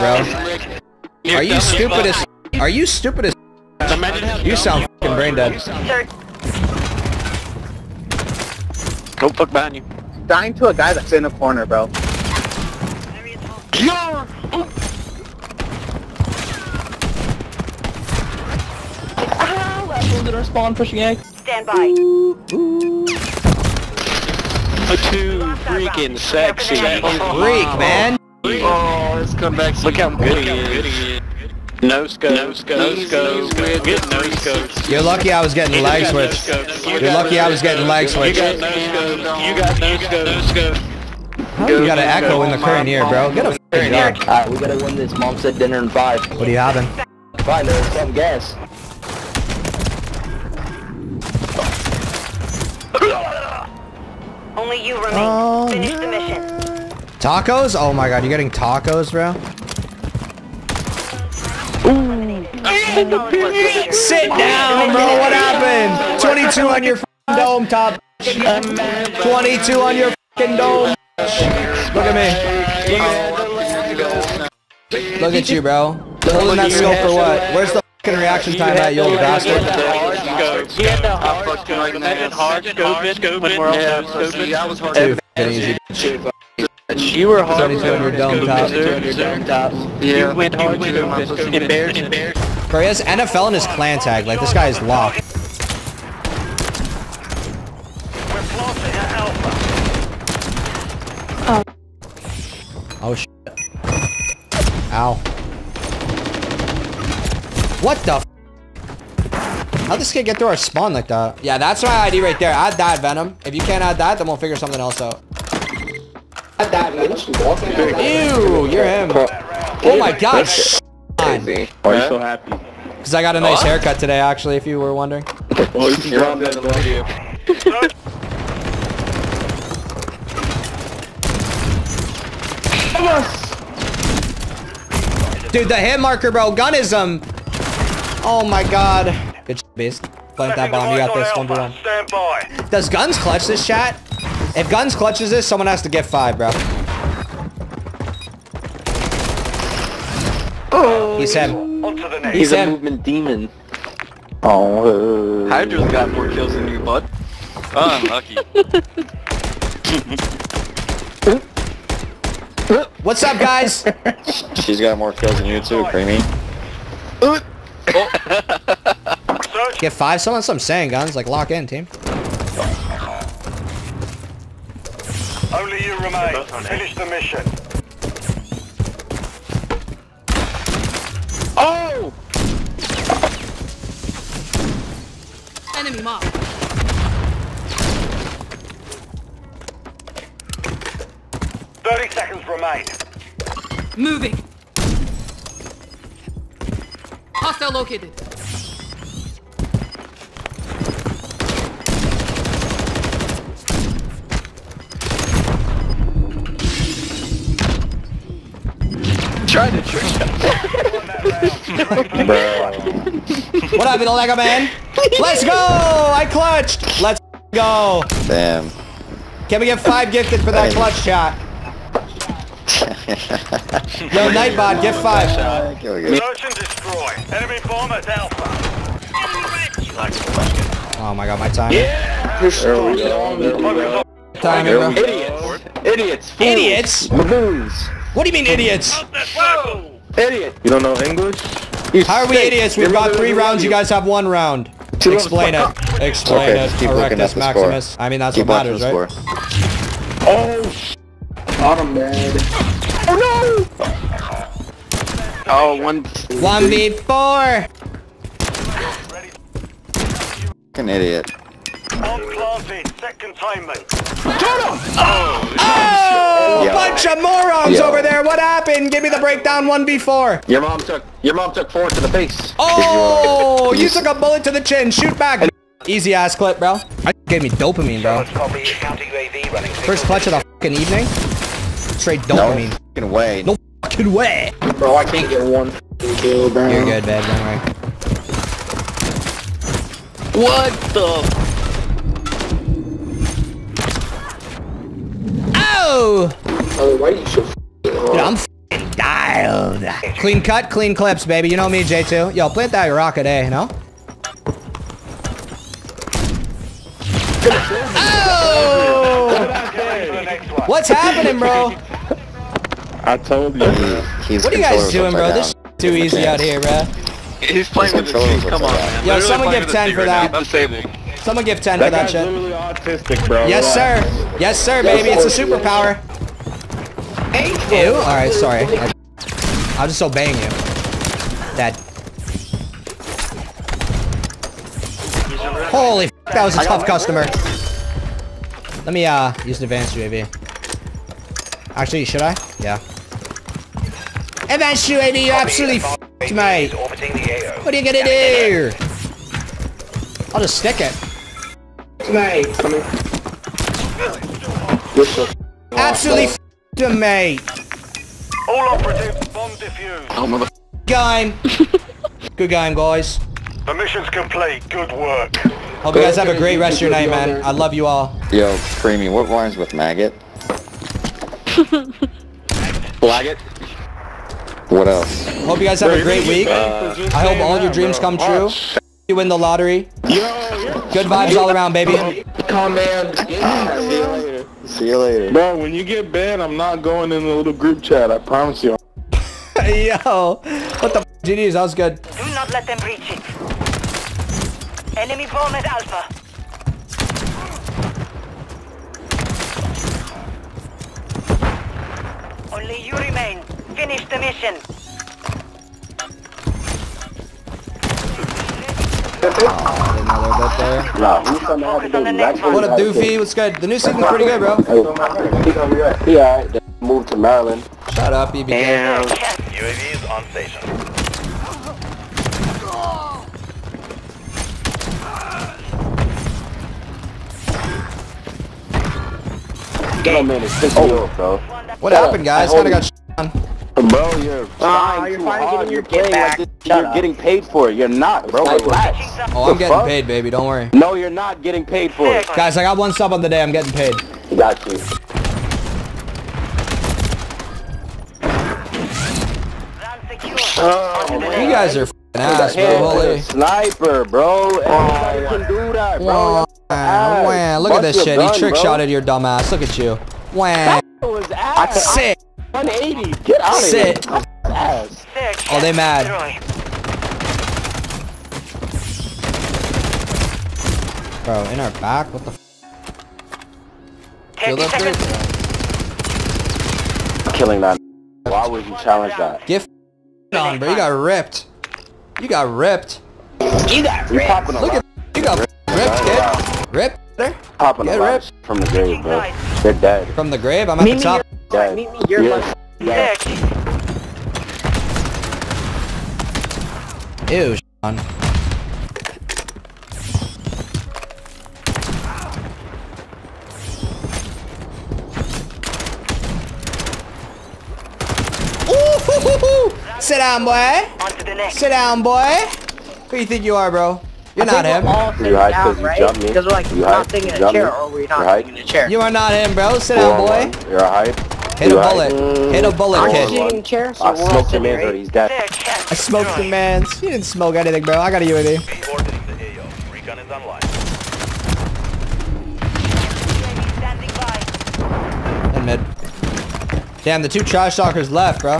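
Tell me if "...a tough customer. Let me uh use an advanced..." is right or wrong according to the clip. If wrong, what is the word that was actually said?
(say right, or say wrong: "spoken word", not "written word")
right.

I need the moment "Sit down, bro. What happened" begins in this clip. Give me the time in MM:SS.
01:03.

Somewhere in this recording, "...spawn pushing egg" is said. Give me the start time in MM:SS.
00:20.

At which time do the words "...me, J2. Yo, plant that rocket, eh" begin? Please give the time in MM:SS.
05:01.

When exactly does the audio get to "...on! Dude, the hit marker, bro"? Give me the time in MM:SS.
02:13.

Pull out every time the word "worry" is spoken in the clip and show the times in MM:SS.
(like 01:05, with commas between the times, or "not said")
04:47, 07:20.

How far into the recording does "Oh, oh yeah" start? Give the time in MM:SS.
04:24.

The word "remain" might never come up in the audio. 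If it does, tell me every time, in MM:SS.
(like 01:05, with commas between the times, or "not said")
00:54, 02:55, 06:42.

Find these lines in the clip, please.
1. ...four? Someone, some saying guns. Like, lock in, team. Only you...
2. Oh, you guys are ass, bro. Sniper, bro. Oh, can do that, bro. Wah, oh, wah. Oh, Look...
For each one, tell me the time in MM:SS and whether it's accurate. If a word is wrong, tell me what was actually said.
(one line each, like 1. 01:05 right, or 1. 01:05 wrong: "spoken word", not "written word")
1. 02:49 wrong: "five", not "four"
2. 07:30 right.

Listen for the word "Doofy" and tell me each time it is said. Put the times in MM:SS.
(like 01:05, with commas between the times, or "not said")
06:52.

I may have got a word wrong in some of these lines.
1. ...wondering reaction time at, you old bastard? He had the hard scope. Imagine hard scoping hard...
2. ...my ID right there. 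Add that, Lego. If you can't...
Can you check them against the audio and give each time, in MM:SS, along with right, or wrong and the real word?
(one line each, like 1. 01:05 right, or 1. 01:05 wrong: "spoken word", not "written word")
1. 01:18 wrong: "fucking", not "wondering"
2. 01:51 wrong: "Venom", not "Lego".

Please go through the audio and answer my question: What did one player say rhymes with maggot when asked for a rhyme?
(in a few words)
Lag it.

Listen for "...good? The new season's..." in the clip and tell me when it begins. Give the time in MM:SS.
06:53.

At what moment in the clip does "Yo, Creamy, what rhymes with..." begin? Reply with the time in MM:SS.
06:08.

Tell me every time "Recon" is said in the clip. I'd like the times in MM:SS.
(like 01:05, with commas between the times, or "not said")
08:49.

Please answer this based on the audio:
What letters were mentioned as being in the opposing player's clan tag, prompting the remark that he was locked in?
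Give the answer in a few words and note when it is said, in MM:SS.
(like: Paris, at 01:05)
NFL, at 01:33.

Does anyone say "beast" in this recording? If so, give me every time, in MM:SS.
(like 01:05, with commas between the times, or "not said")
02:19.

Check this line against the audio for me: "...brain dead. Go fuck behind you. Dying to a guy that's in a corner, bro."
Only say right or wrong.
right.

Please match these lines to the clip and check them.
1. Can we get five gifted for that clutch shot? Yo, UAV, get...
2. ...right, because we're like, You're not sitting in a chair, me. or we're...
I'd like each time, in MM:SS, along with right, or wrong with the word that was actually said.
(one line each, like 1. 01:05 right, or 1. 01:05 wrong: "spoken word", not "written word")
1. 03:39 wrong: "Nightbot", not "UAV"
2. 08:35 right.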